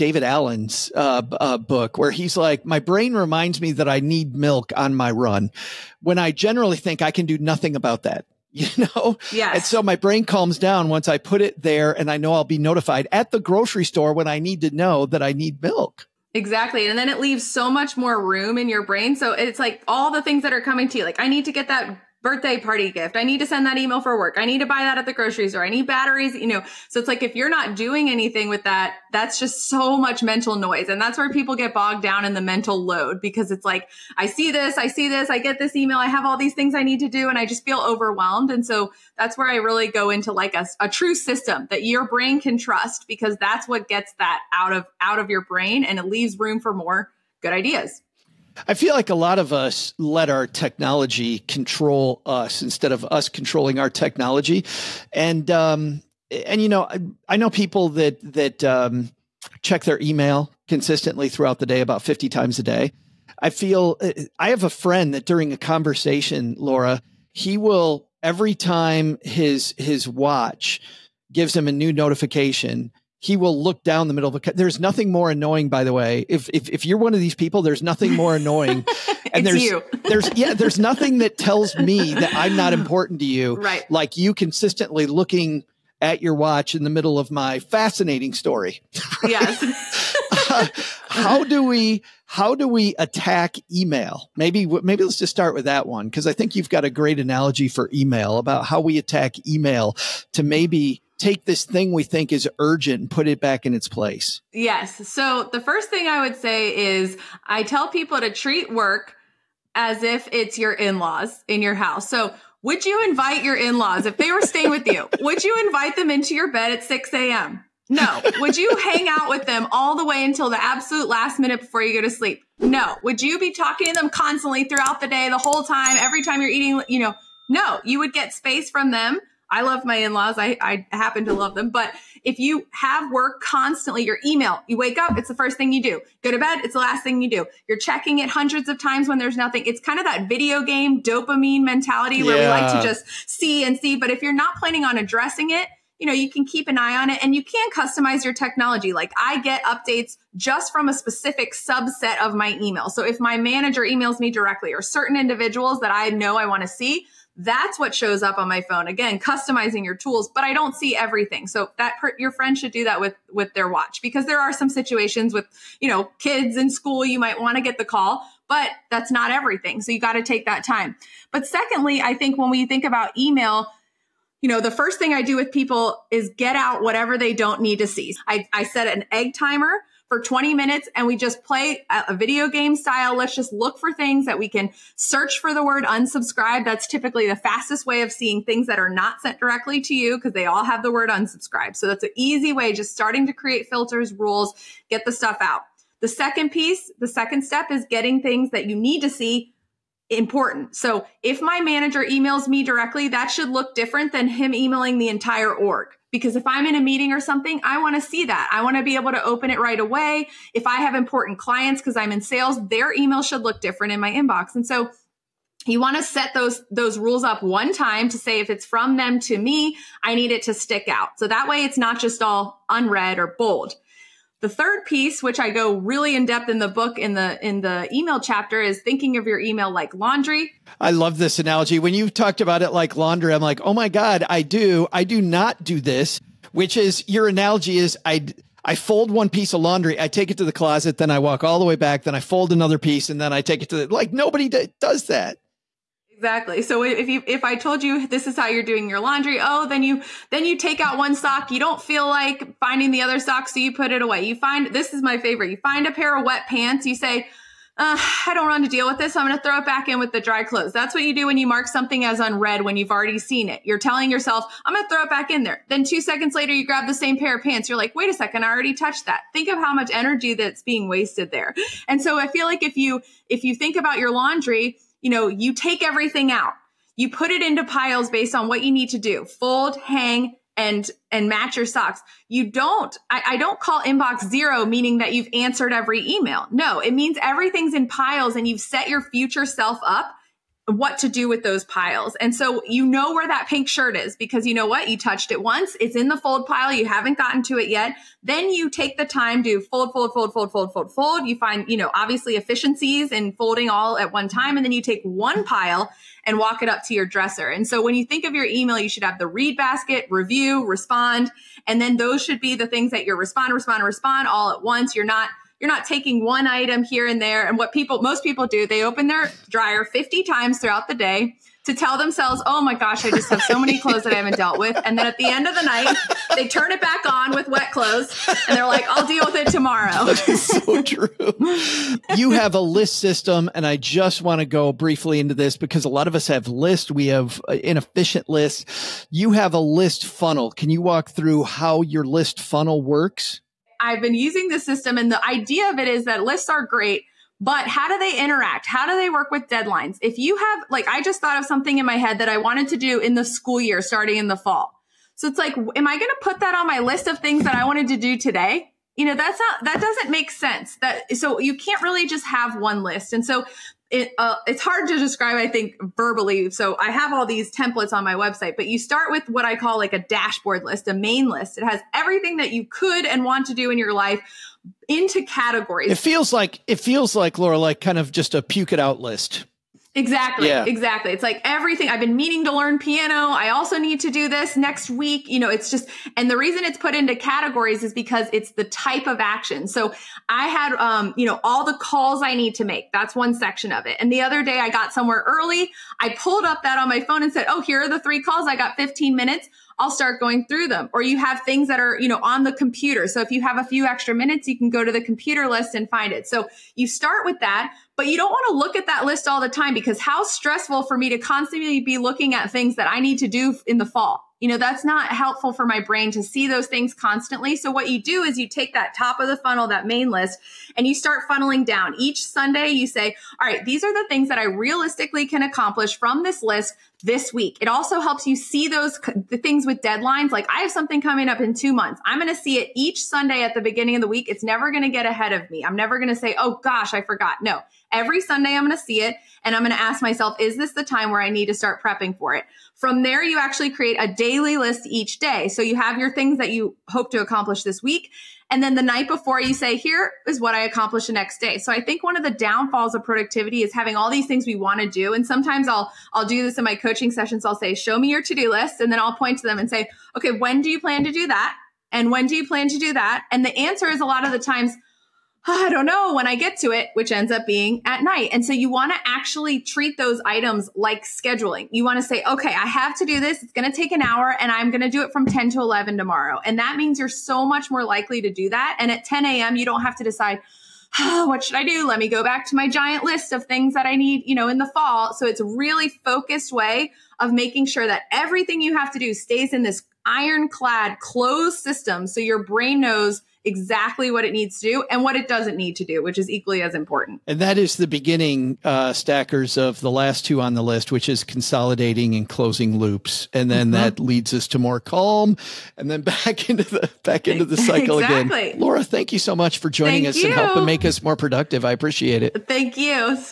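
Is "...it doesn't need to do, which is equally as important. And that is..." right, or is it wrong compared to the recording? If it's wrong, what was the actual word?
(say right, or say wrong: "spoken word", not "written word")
right.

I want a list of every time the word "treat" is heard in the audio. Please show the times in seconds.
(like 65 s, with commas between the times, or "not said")
108 s, 469 s.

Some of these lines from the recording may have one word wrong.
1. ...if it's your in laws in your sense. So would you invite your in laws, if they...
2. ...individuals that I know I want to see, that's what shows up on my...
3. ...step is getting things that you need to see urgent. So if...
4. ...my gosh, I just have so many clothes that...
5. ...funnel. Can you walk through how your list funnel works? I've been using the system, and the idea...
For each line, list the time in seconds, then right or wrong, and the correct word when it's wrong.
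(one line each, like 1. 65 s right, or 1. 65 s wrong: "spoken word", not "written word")
1. 110 s wrong: "house", not "sense"
2. 155 s right
3. 197 s wrong: "important", not "urgent"
4. 322 s right
5. 340 s right.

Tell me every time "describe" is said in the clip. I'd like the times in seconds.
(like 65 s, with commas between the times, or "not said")
364 s.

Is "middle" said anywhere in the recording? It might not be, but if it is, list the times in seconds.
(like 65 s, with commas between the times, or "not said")
74 s, 86 s.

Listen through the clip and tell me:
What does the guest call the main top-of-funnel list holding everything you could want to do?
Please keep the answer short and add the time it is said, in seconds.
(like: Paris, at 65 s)
Dashboard list, at 369 s.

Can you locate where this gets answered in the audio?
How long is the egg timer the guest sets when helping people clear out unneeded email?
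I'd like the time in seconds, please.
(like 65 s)
180 s.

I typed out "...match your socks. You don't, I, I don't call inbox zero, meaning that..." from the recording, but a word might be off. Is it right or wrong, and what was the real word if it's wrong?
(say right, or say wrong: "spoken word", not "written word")
right.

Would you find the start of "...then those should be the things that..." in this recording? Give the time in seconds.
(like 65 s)
311 s.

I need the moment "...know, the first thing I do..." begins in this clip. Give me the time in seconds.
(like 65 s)
174 s.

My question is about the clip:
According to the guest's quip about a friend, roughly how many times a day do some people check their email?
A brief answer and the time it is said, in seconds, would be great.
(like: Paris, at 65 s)
50, at 62 s.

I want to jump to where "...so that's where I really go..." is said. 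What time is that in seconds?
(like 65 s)
38 s.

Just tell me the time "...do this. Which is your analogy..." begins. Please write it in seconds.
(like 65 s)
235 s.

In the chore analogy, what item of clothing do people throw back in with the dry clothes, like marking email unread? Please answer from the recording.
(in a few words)
Wet pants.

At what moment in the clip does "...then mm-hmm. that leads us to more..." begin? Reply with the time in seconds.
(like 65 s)
503 s.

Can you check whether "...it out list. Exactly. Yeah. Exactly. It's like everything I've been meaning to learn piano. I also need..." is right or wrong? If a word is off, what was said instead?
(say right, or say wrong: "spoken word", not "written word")
right.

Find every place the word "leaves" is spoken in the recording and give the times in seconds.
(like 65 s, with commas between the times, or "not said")
17 s, 46 s.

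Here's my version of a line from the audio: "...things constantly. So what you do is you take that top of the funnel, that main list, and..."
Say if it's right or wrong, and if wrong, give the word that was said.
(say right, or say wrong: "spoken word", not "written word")
right.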